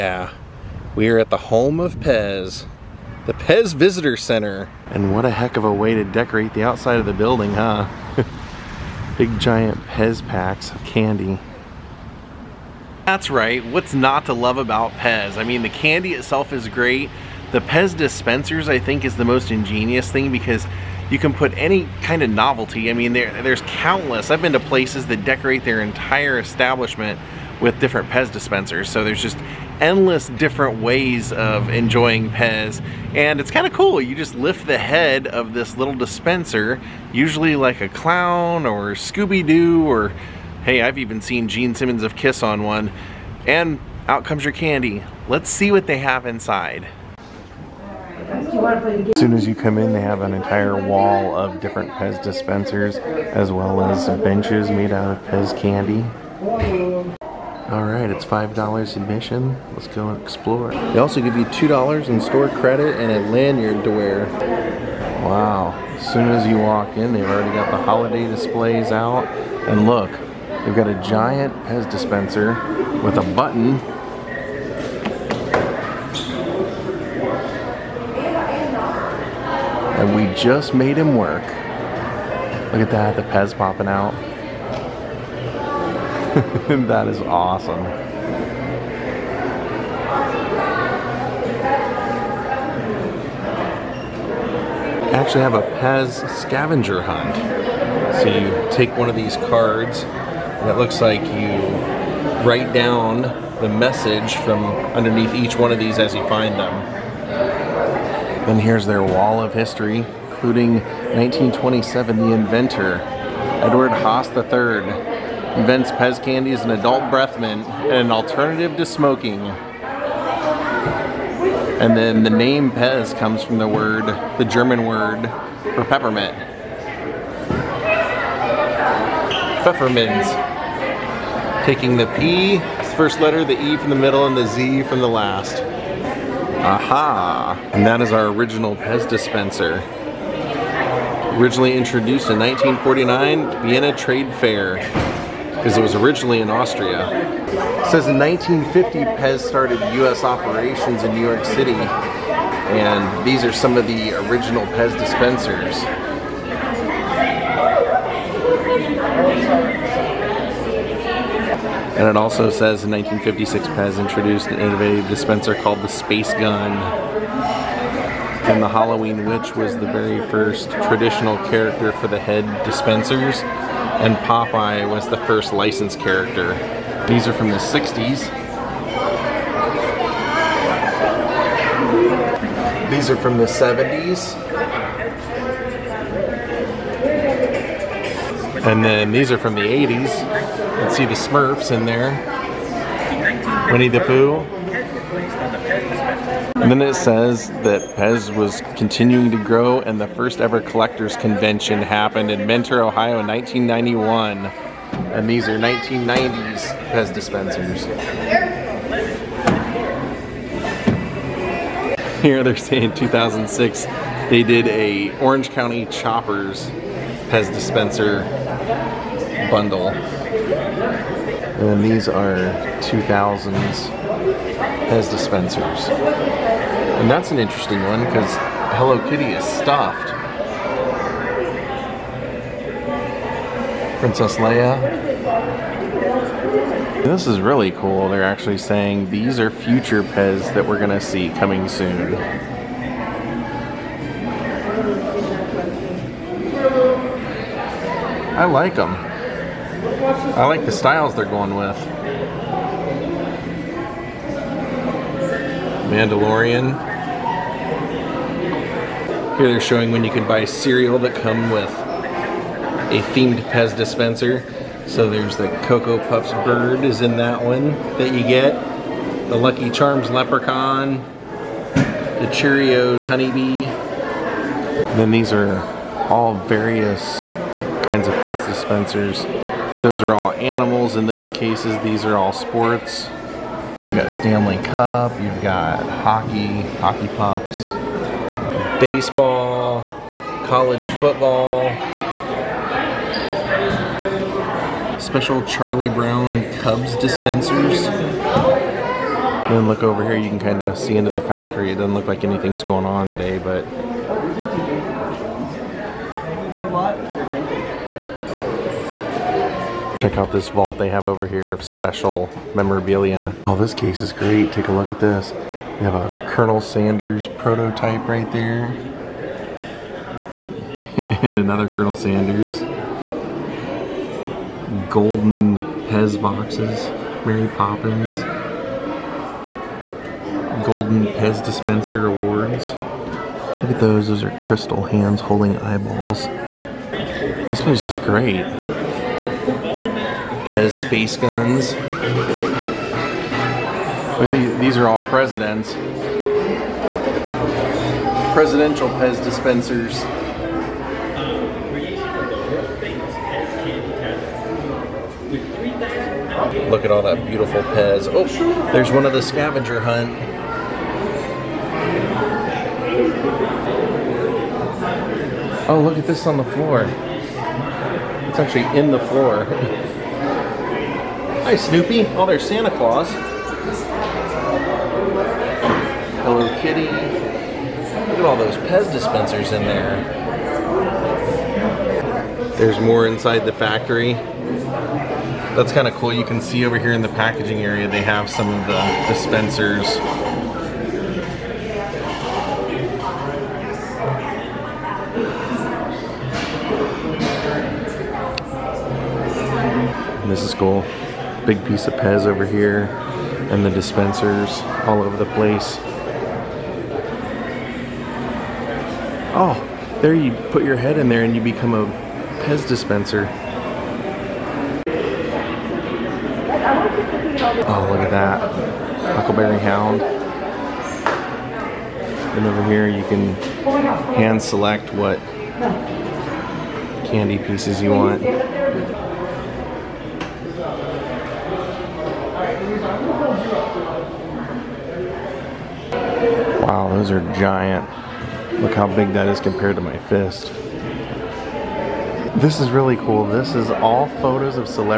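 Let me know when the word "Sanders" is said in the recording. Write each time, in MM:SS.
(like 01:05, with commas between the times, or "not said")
05:16, 05:21.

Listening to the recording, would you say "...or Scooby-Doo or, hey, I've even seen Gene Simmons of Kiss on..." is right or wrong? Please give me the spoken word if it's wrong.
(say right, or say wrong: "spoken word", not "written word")
right.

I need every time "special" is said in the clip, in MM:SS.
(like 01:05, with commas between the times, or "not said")
04:54, 05:11.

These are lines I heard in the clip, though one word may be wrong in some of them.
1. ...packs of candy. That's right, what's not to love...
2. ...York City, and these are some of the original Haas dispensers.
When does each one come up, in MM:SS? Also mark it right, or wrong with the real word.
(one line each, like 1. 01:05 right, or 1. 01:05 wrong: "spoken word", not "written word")
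1. 00:10 right
2. 02:31 wrong: "Pez", not "Haas".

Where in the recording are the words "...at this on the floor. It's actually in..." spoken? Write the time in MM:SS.
06:05.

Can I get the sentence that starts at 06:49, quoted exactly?
Oh, there you put your head in there and you become a Pez dispenser.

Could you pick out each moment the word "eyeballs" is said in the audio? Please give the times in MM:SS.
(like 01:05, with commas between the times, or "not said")
05:35.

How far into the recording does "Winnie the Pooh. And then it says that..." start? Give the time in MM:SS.
03:13.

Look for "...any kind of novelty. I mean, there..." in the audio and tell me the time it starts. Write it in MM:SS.
00:21.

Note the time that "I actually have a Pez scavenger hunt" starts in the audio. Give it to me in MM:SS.
01:35.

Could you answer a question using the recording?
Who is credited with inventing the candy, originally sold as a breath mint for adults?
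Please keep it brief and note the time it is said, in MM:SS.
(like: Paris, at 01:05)
Edward Haas III, at 01:53.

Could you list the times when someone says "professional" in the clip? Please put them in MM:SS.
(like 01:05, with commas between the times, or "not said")
not said.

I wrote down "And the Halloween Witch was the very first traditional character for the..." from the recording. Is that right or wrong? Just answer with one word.
right.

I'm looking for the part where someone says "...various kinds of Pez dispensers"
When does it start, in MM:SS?
04:36.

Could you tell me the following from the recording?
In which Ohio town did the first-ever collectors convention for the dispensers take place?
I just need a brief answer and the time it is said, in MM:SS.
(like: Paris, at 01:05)
Mentor, Ohio, at 03:22.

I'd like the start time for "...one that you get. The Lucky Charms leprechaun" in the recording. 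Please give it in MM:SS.
04:27.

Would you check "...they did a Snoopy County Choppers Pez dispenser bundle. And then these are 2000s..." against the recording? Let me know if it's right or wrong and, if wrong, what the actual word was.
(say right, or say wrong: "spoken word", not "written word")
wrong: "Orange", not "Snoopy".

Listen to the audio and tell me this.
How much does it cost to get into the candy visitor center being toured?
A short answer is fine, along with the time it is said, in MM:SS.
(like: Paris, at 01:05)
$5, at 00:58.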